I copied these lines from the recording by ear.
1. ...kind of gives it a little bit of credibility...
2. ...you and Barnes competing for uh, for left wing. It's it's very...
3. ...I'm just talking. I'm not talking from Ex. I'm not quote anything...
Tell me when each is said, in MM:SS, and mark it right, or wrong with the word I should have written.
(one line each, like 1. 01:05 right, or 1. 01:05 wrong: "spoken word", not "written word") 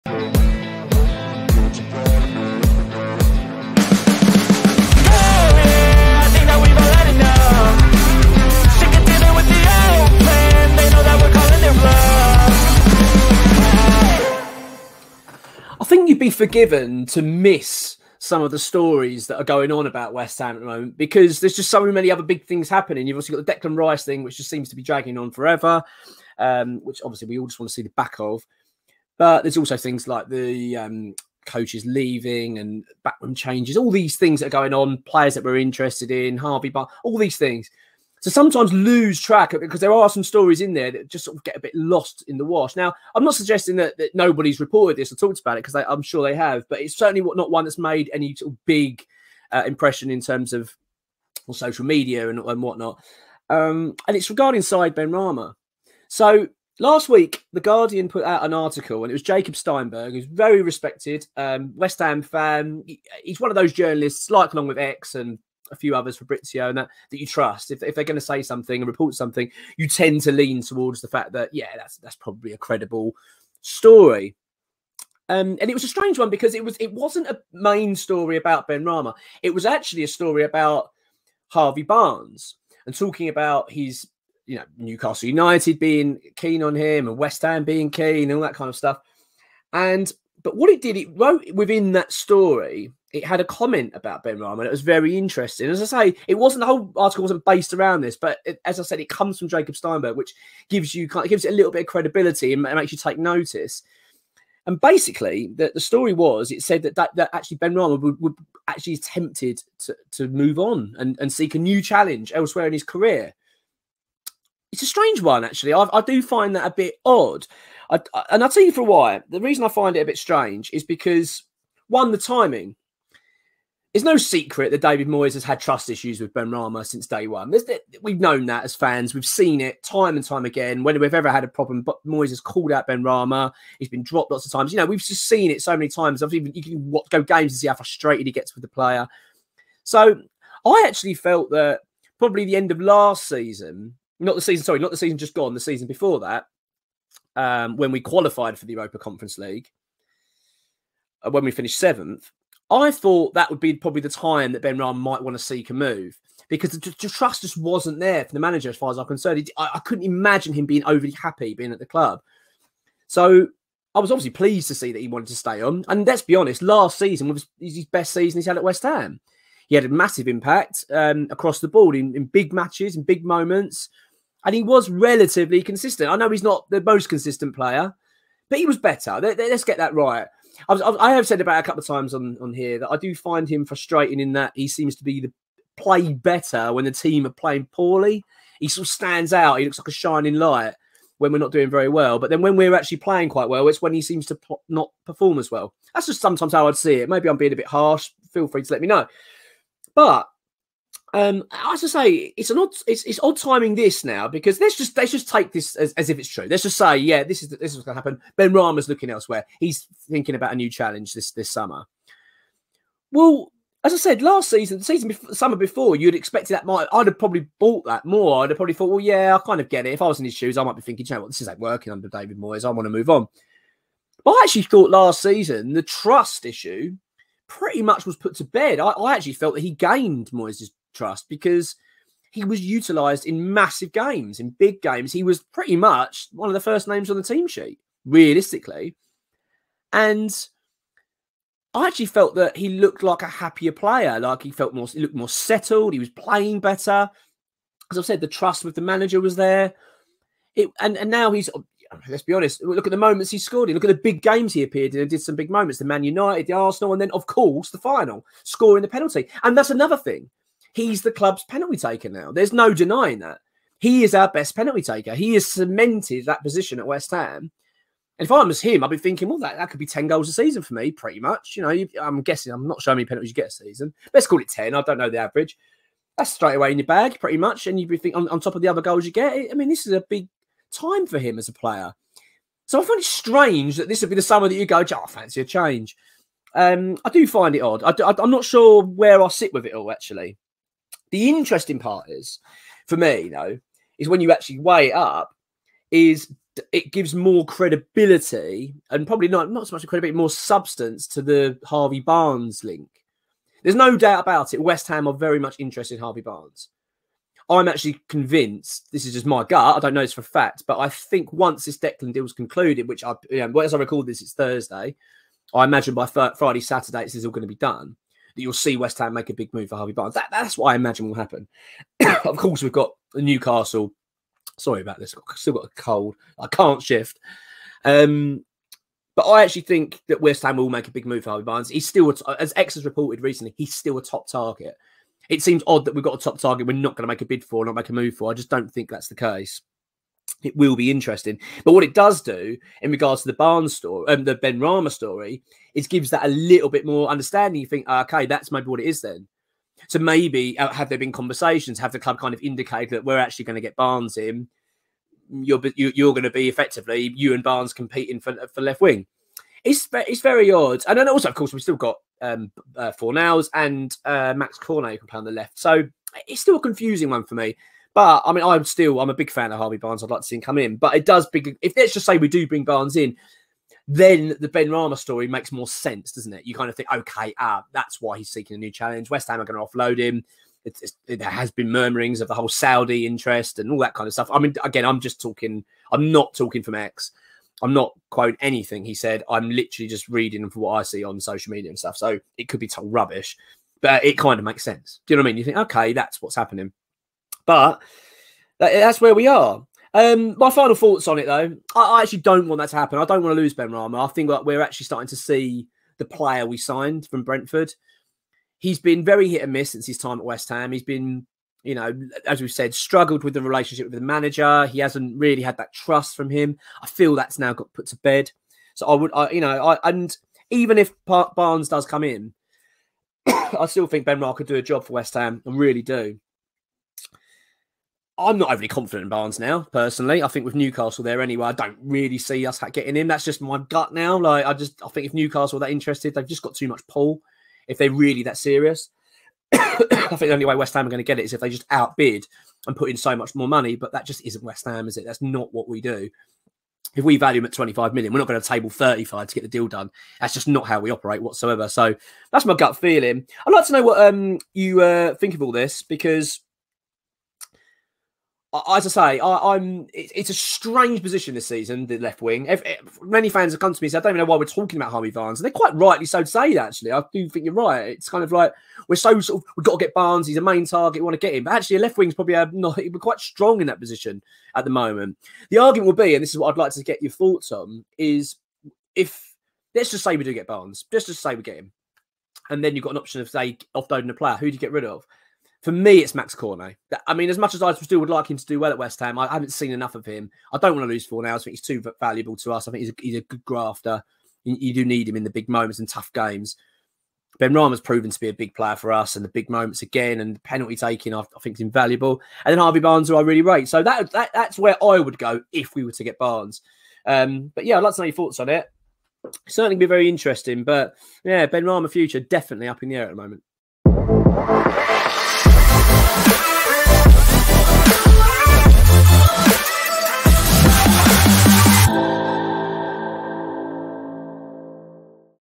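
1. 01:41 right
2. 05:57 right
3. 06:24 right.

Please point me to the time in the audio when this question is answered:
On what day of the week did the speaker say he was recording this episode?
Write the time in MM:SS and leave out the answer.
05:14.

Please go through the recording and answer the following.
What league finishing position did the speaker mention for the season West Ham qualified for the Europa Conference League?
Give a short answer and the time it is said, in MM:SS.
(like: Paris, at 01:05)
7th, at 02:31.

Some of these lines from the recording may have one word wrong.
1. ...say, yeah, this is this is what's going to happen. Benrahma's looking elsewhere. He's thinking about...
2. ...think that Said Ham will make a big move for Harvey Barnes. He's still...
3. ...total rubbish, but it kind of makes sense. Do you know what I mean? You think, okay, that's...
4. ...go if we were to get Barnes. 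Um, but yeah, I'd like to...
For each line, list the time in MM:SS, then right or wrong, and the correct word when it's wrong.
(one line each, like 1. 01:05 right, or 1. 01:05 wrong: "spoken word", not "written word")
1. 03:26 right
2. 05:29 wrong: "West", not "Said"
3. 06:32 right
4. 08:25 right.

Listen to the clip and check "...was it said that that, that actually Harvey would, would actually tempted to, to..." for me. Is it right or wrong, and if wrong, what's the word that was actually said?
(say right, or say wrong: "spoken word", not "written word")
wrong: "Benrahma", not "Harvey".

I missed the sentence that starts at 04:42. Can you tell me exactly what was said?
So I find it strange that this would be the summer that you go, oh, I fancy a change.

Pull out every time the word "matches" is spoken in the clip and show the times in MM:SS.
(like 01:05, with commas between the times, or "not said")
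02:52.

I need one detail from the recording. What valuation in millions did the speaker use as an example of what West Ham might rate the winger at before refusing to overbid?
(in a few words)
25 million.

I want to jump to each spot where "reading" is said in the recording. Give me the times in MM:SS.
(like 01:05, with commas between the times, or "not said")
06:30.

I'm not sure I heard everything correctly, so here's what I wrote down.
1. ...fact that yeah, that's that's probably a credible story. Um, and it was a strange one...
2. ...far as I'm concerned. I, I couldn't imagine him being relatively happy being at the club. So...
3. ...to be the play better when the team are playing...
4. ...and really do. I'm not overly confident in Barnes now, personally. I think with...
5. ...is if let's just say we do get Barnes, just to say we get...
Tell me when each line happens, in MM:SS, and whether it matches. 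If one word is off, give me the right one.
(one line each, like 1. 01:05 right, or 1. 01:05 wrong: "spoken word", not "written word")
1. 01:11 right
2. 02:38 wrong: "overly", not "relatively"
3. 03:04 right
4. 07:05 right
5. 07:57 right.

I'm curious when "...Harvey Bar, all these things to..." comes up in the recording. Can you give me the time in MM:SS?
00:36.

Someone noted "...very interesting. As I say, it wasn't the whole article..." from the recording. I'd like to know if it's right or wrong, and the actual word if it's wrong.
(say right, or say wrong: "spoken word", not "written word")
right.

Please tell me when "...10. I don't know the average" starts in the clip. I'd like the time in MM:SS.
04:34.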